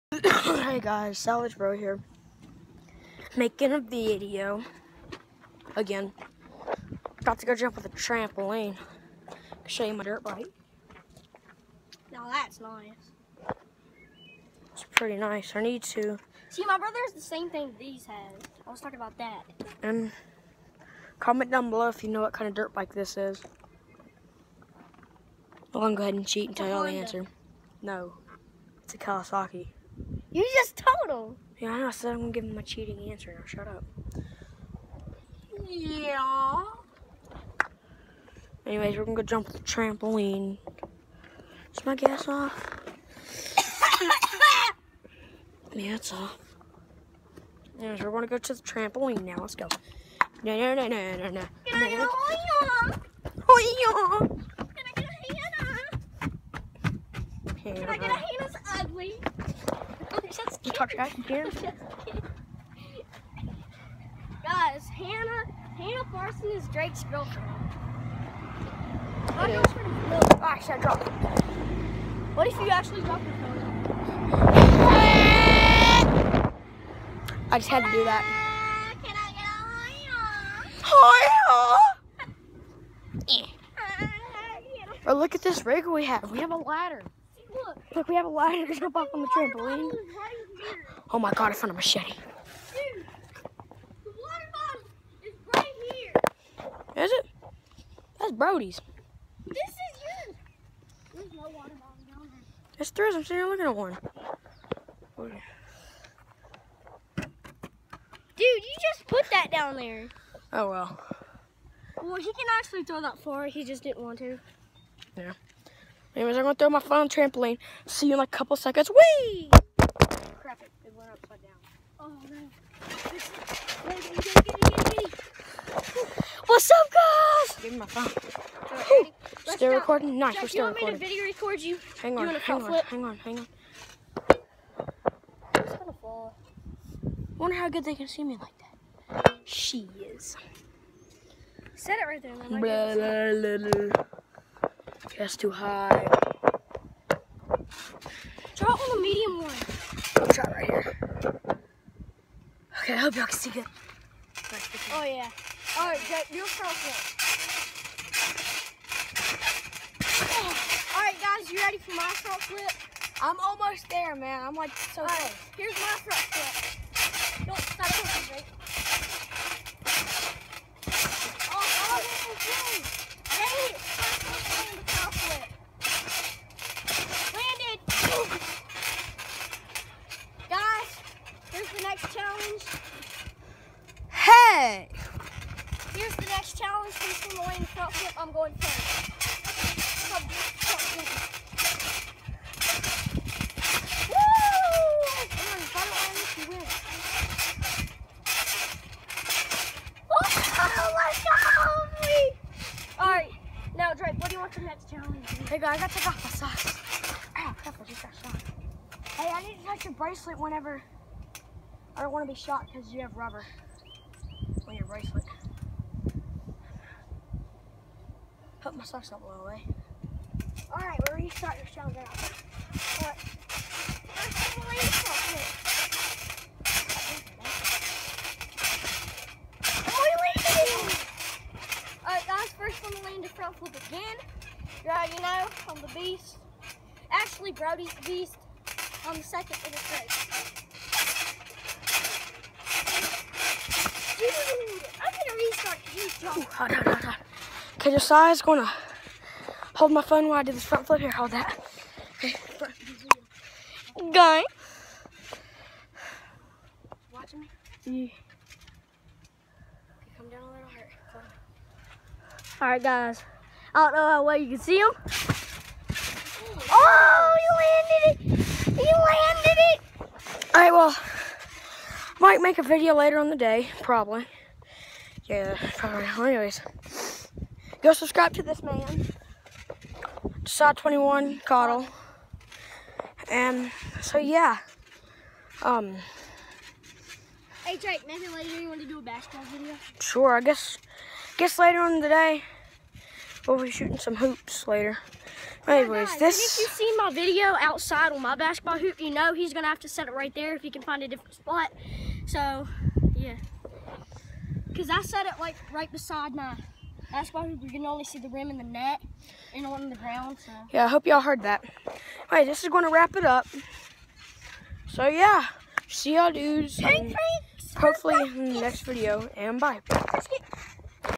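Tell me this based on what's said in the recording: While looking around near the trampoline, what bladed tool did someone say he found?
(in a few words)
A machete.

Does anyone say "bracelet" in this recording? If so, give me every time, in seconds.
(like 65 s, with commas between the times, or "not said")
209 s, 214 s.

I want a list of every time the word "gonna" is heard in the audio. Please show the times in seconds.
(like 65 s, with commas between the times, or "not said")
116 s, 248 s.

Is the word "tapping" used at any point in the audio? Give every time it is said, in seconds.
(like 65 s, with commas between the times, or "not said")
not said.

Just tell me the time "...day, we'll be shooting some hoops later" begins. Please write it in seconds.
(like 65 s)
292 s.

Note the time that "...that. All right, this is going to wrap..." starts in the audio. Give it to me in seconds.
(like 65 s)
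311 s.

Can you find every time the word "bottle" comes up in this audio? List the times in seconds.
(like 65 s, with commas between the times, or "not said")
94 s, 101 s.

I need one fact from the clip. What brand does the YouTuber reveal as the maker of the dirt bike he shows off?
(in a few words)
Kawasaki.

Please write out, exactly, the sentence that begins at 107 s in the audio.
Dude, you just put that down there.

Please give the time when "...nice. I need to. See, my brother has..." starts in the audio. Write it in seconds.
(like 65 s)
15 s.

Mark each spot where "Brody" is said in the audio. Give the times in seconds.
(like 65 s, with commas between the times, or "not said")
98 s, 237 s.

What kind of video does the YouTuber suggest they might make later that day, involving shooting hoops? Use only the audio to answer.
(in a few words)
Basketball video.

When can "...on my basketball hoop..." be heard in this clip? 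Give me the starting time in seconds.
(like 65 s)
298 s.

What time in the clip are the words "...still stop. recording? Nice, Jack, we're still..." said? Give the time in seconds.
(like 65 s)
129 s.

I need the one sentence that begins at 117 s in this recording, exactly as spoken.
See you in like a couple seconds.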